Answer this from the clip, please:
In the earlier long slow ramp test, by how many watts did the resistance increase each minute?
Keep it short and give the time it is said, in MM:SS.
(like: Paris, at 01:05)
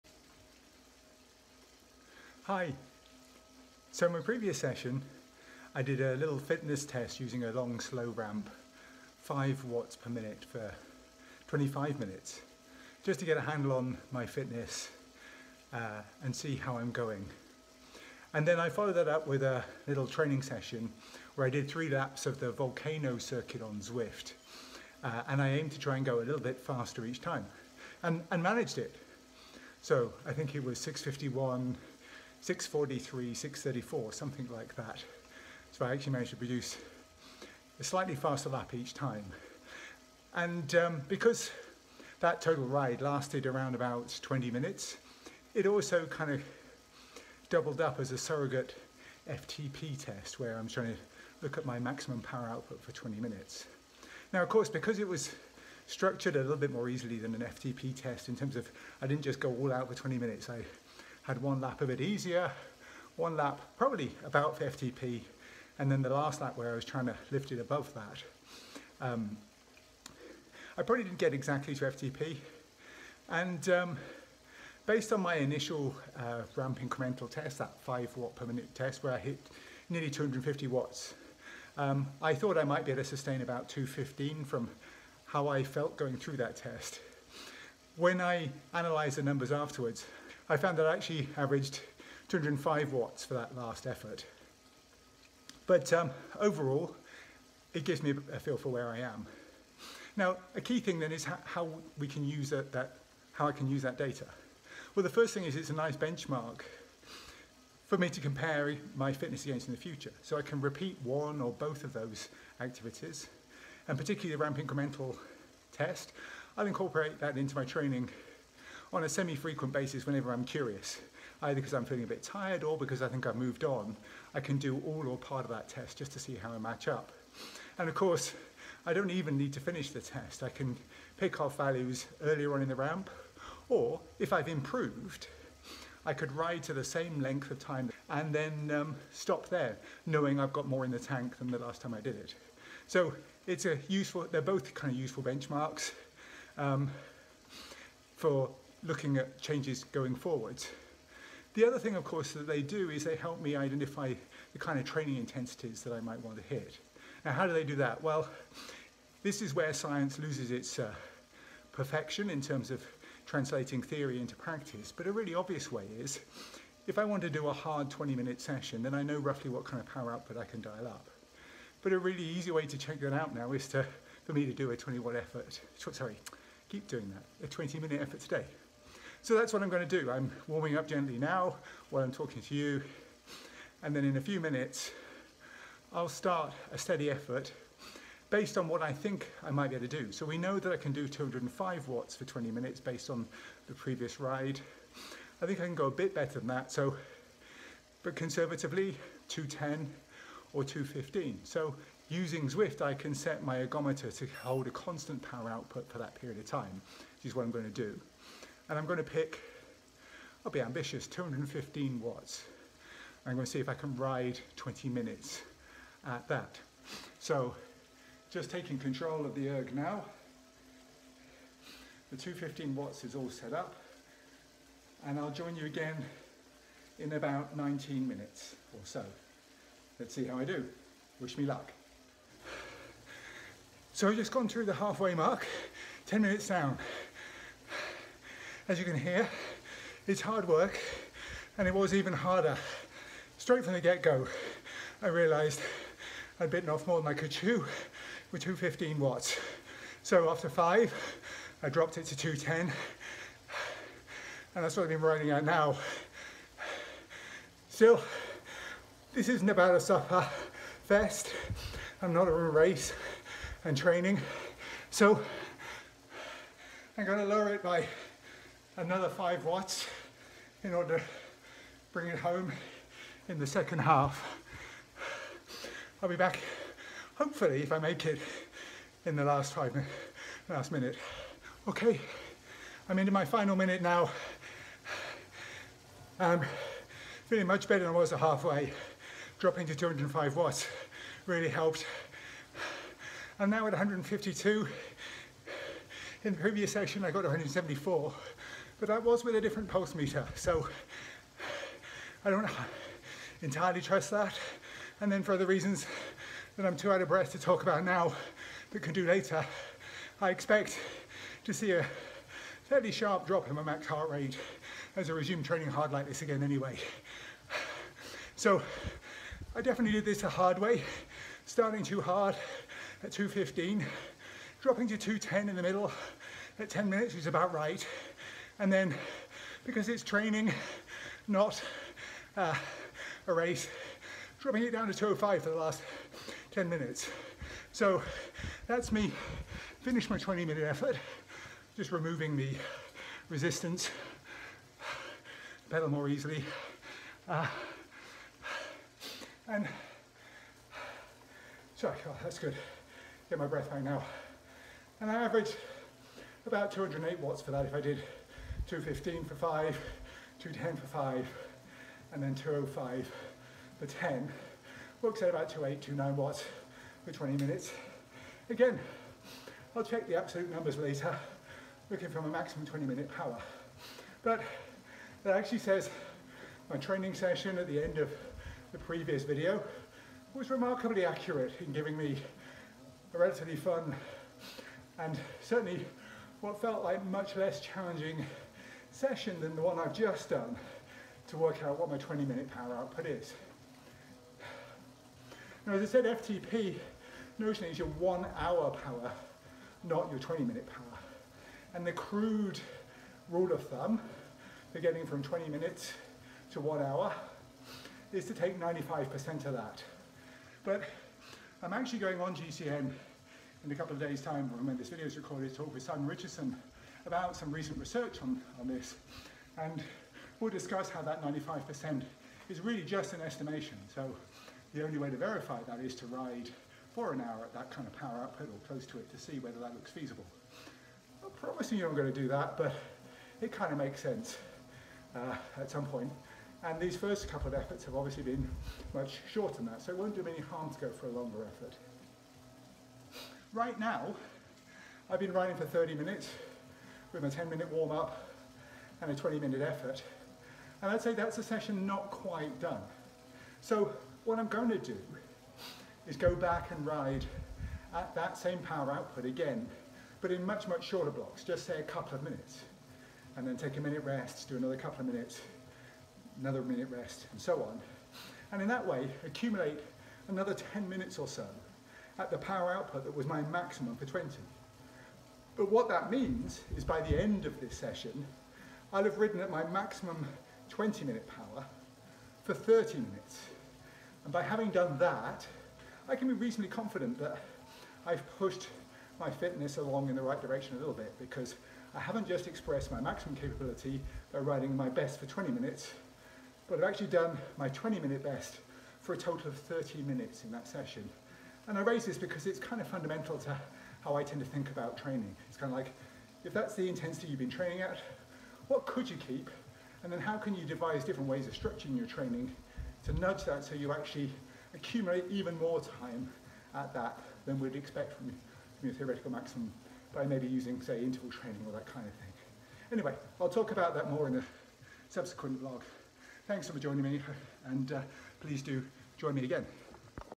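5 watts, at 00:09.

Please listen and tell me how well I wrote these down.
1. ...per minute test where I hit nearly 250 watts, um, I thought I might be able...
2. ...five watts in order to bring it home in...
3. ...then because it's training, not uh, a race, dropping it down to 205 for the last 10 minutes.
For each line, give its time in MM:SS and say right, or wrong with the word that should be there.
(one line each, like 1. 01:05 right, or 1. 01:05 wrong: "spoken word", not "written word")
1. 01:18 right
2. 04:29 right
3. 05:28 right.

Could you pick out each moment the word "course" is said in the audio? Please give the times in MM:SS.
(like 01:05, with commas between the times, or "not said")
00:54, 02:07, 02:32.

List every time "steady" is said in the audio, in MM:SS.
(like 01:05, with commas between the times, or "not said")
03:06.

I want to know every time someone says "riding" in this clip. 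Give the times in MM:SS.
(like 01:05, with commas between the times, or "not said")
04:15, 08:14.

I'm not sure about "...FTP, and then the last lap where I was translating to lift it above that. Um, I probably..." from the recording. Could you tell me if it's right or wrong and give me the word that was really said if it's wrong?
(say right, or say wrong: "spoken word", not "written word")
wrong: "trying", not "translating".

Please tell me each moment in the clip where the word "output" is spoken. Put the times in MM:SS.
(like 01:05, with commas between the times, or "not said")
00:52, 02:50, 03:25, 06:32, 07:08, 07:38, 07:52.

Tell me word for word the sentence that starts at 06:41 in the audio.
And the crude rule of thumb for getting from 20 minutes to one hour is to take 95% of that.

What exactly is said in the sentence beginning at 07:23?
Right now, I've been running for 30 minutes with a 10 minute warm up and a 20 minute effort.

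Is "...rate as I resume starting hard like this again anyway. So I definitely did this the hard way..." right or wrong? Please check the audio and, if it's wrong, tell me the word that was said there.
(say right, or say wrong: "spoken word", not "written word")
wrong: "training", not "starting".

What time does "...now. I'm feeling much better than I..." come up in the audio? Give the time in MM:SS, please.
04:43.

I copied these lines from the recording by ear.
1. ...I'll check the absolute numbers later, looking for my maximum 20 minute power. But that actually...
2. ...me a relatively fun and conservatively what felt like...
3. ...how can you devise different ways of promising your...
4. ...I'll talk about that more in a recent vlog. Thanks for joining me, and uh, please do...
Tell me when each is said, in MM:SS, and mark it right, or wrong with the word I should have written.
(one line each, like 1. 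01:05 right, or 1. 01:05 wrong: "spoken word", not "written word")
1. 06:09 right
2. 06:21 wrong: "certainly", not "conservatively"
3. 08:30 wrong: "structuring", not "promising"
4. 08:43 wrong: "subsequent", not "recent".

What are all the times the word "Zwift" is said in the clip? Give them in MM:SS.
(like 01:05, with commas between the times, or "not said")
00:23, 03:22.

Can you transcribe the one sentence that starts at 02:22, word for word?
So it's a useful, they're both kind of useful benchmarks um, for looking at changes going forwards.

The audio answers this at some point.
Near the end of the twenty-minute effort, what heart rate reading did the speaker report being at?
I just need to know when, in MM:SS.
04:53.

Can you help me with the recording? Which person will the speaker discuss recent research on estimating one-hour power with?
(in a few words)
Simon Richardson.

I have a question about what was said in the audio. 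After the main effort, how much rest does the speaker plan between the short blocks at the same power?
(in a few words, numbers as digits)
a minute.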